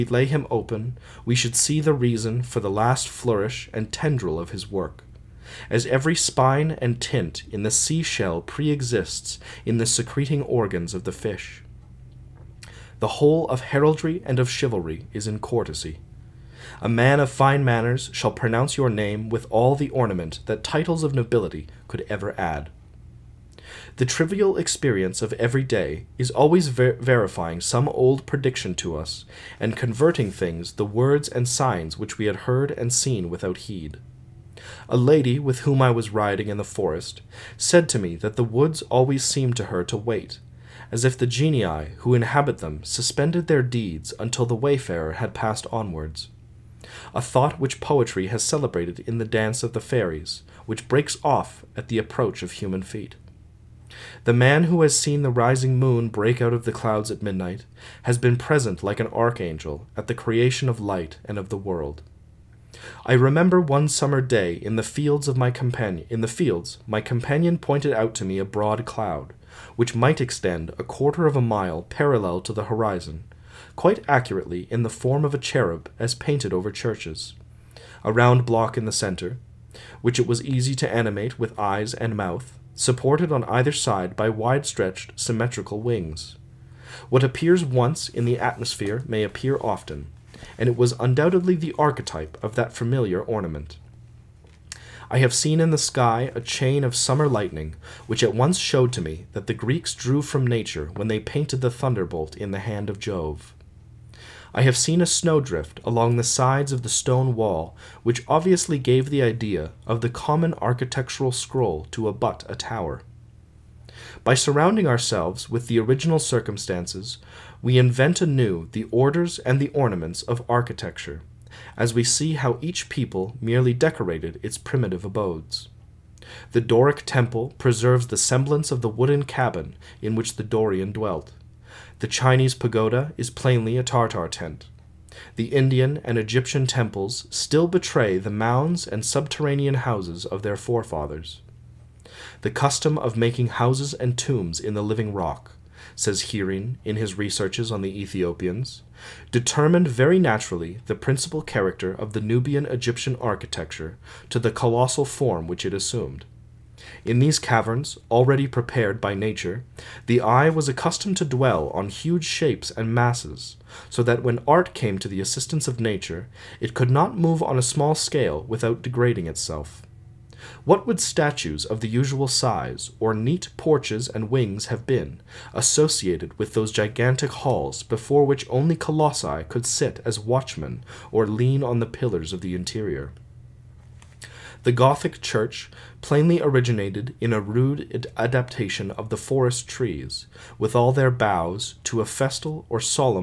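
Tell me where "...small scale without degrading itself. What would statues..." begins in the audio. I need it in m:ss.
2:47.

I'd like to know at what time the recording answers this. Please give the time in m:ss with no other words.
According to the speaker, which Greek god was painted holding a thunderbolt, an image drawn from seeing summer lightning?
1:42.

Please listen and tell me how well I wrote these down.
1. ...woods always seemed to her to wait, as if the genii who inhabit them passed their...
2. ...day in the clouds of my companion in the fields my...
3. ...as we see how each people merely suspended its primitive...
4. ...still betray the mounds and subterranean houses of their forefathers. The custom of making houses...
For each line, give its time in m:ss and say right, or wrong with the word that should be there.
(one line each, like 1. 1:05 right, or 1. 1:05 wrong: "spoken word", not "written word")
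1. 0:38 wrong: "suspended", not "passed"
2. 1:04 wrong: "fields", not "clouds"
3. 2:01 wrong: "decorated", not "suspended"
4. 2:17 right.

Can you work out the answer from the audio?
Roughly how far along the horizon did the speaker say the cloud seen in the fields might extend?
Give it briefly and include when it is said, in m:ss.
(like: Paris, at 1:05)
a quarter of a mile, at 1:10.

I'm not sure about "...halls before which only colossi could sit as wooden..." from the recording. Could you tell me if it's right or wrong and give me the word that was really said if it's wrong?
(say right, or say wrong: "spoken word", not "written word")
wrong: "watchmen", not "wooden".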